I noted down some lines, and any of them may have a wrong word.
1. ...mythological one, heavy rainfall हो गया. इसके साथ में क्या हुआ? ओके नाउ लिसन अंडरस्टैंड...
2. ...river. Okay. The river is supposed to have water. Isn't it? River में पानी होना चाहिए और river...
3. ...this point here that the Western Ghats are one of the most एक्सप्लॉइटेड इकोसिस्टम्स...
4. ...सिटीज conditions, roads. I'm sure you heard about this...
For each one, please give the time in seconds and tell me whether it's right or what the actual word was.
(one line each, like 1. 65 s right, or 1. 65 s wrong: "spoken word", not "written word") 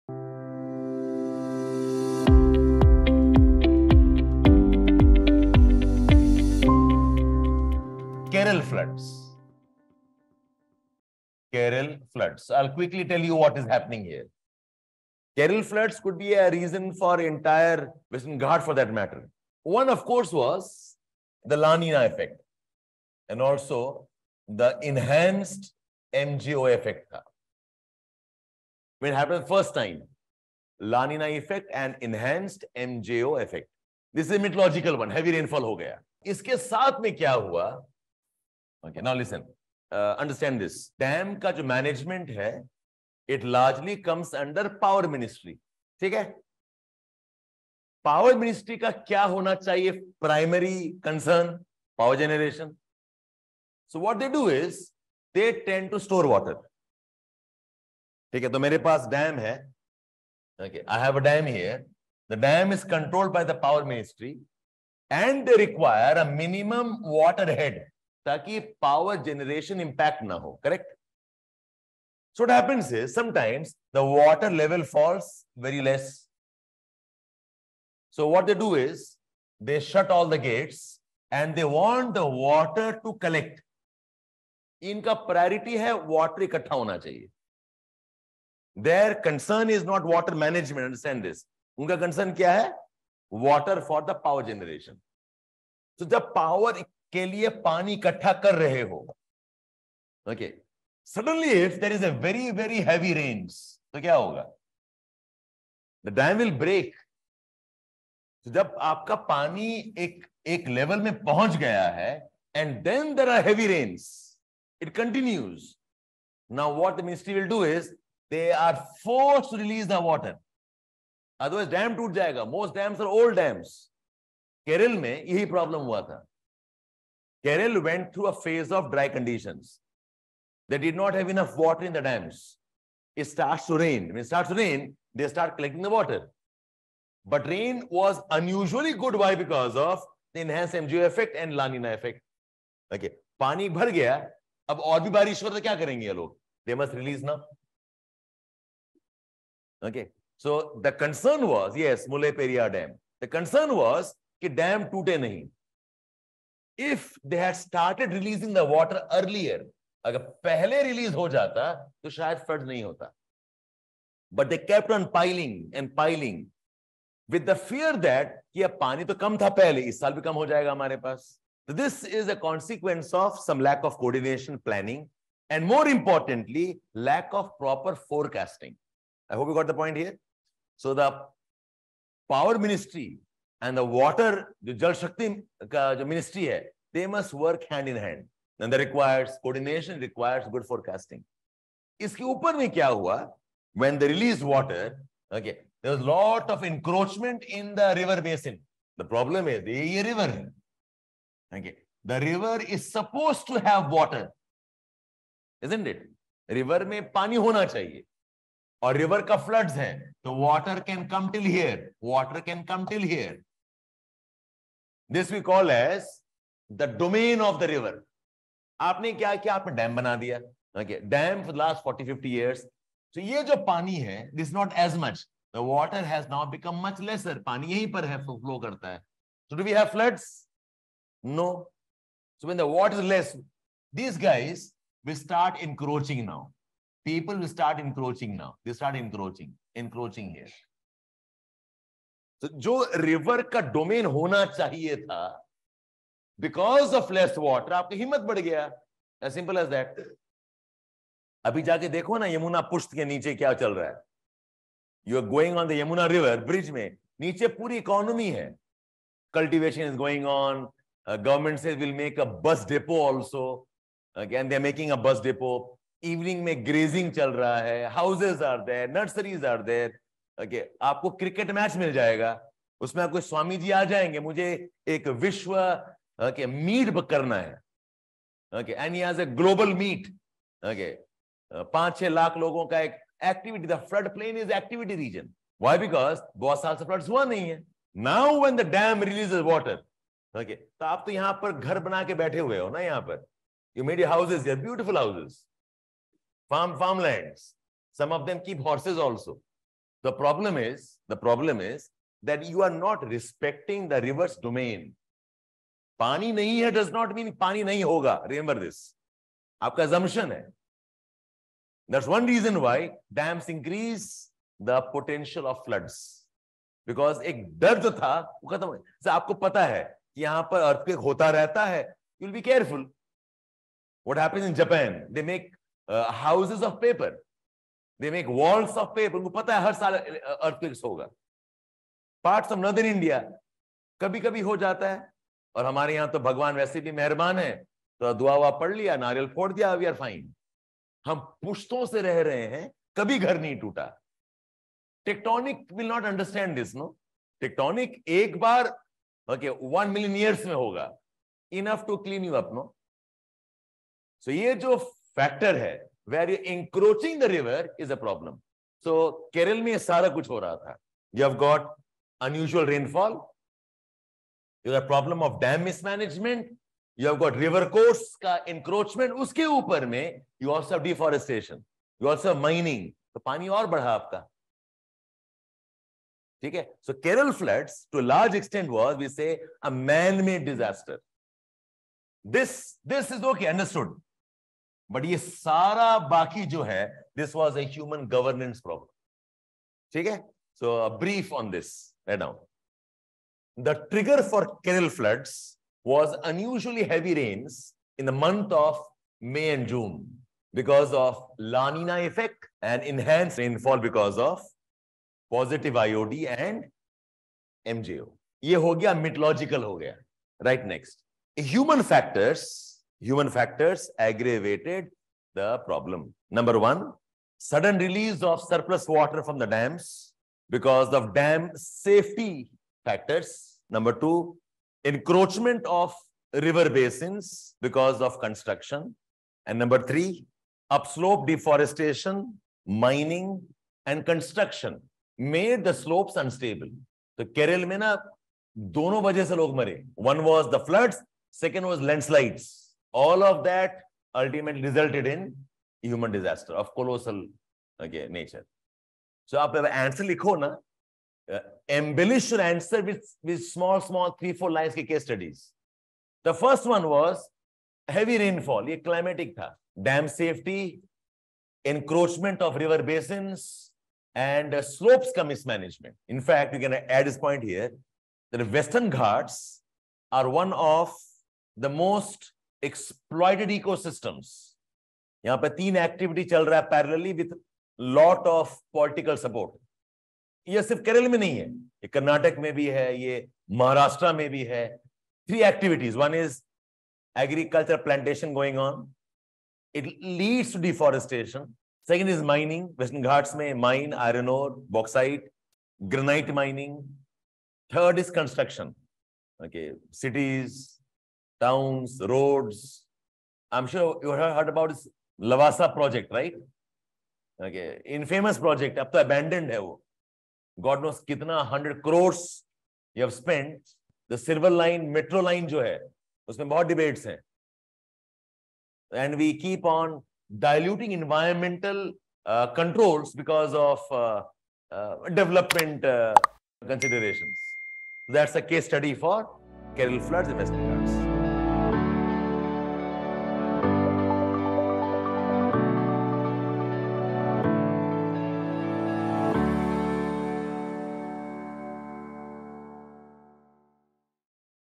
1. 34 s right
2. 200 s right
3. 467 s right
4. 499 s wrong: "towns", not "conditions".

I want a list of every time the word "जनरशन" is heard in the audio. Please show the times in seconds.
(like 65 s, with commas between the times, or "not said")
52 s, 69 s, 94 s.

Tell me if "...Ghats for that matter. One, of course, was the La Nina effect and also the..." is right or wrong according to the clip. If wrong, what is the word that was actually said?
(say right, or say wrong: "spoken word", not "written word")
right.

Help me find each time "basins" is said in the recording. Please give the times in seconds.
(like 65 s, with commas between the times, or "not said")
198 s, 426 s, 462 s.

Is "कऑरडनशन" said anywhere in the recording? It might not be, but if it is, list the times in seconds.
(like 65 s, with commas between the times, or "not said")
173 s.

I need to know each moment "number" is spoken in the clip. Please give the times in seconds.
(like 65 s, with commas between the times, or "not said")
416 s, 423 s, 429 s.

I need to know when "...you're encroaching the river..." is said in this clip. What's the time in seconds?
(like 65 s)
356 s.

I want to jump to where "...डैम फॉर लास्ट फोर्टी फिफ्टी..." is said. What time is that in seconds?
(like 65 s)
221 s.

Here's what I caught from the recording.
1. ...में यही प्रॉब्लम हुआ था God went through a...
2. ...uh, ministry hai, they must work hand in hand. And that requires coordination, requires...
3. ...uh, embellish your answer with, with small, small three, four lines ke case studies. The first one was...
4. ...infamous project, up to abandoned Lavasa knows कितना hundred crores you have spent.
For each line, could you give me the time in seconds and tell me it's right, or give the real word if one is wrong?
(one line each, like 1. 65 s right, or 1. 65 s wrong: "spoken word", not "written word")
1. 125 s wrong: "Kerala", not "God"
2. 185 s right
3. 451 s right
4. 507 s wrong: "God", not "Lavasa".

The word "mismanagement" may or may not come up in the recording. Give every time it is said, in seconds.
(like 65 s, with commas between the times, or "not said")
365 s, 465 s.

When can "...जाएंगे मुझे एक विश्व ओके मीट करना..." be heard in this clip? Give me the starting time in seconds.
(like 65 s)
273 s.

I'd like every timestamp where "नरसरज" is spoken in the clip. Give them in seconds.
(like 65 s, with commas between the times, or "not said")
268 s.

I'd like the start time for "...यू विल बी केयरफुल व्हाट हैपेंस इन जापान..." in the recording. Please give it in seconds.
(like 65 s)
321 s.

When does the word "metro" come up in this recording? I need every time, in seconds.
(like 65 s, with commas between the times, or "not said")
514 s.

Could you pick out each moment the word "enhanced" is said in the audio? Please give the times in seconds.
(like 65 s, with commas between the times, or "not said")
24 s, 32 s, 140 s.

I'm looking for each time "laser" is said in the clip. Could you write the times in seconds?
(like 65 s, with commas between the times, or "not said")
not said.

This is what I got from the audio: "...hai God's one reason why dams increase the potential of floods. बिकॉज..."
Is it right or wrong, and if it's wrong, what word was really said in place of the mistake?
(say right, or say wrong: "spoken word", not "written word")
wrong: "That", not "God".